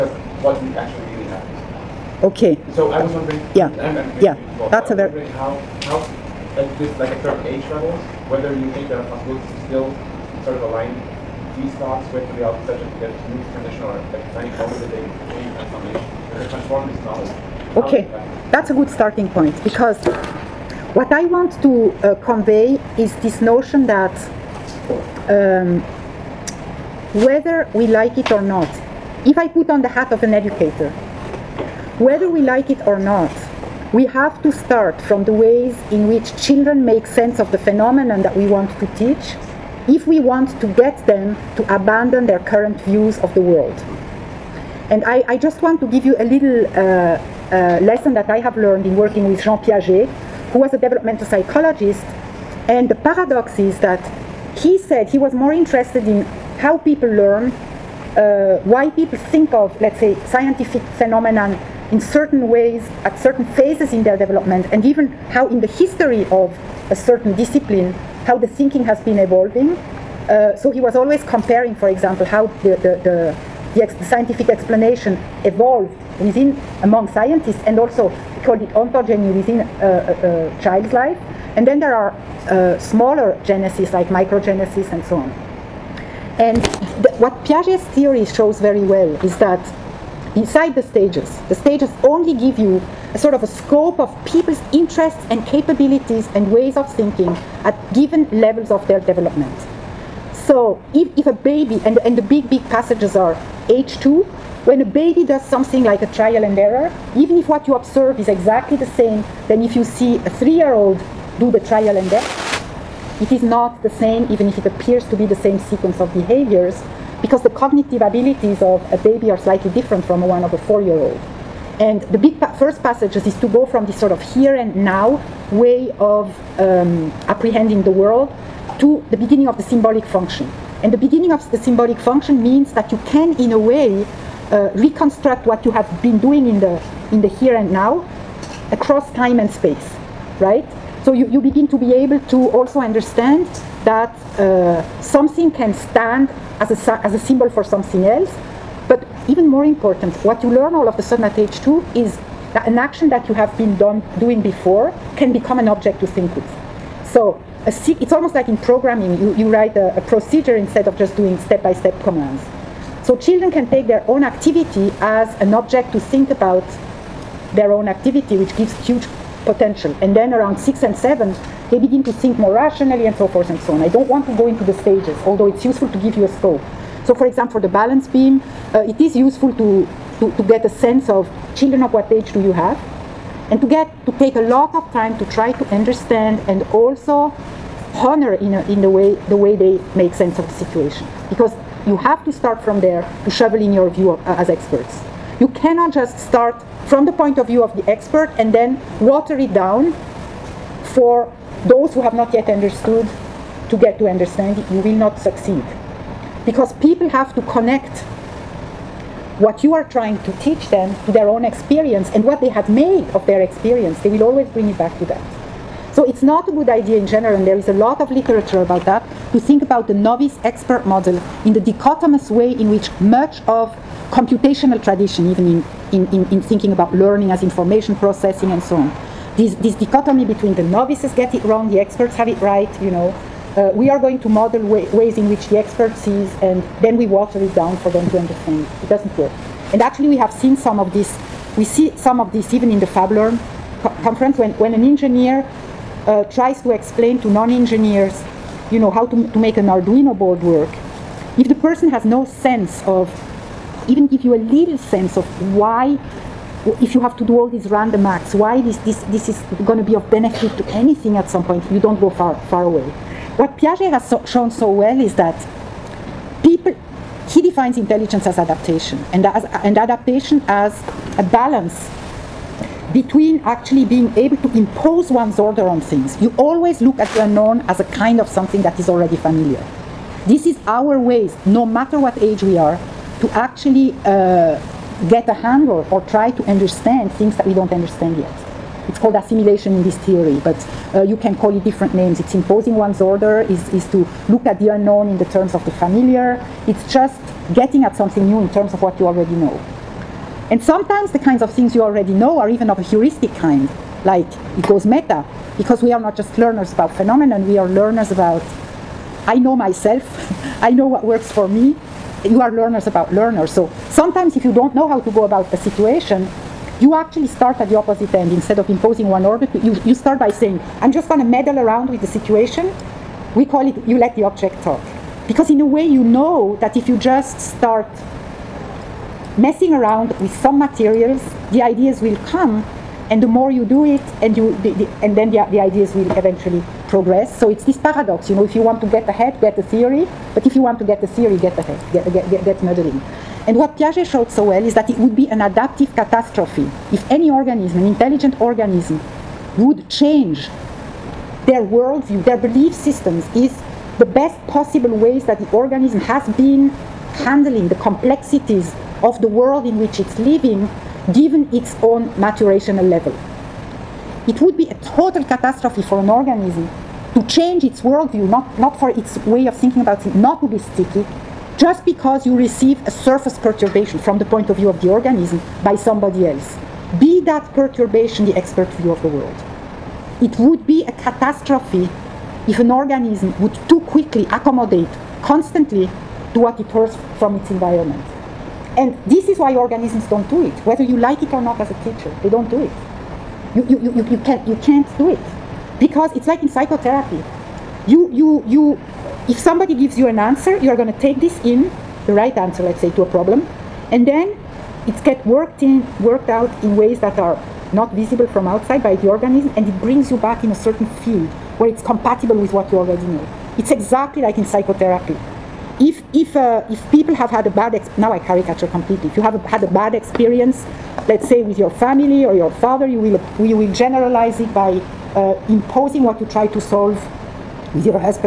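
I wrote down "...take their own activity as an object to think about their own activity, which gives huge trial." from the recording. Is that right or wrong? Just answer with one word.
wrong.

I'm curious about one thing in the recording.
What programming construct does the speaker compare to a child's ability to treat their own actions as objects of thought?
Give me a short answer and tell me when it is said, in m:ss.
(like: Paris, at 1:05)
a procedure, at 2:39.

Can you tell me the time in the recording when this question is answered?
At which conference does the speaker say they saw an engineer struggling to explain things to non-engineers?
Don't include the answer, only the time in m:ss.
4:02.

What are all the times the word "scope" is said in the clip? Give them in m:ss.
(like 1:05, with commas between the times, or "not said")
1:33, 2:56.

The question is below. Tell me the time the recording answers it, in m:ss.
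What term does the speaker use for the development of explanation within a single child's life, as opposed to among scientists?
1:18.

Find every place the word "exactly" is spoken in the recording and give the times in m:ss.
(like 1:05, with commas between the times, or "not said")
1:48, 6:53.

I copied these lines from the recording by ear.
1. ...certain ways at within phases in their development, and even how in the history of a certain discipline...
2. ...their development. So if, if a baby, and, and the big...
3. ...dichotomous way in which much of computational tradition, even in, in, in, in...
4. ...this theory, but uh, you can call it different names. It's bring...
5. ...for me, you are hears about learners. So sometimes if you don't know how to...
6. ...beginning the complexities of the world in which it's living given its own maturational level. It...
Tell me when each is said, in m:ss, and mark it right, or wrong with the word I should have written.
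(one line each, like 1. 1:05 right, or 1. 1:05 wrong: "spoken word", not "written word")
1. 1:01 wrong: "certain", not "within"
2. 1:38 right
3. 3:41 right
4. 4:49 wrong: "imposing", not "bring"
5. 5:11 wrong: "learners", not "hears"
6. 5:57 wrong: "handling", not "beginning".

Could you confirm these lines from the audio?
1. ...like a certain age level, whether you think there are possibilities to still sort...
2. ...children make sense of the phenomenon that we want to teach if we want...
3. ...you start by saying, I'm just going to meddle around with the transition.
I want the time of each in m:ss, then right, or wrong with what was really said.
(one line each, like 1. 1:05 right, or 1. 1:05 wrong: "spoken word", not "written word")
1. 0:06 right
2. 0:36 right
3. 5:19 wrong: "situation", not "transition".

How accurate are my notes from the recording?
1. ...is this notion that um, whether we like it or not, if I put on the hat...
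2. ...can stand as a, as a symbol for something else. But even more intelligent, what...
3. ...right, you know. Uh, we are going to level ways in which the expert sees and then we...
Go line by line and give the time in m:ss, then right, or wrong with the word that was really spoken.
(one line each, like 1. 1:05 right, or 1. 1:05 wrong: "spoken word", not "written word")
1. 0:22 right
2. 2:25 wrong: "important", not "intelligent"
3. 3:52 wrong: "model", not "level".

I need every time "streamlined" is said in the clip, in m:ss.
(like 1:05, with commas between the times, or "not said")
not said.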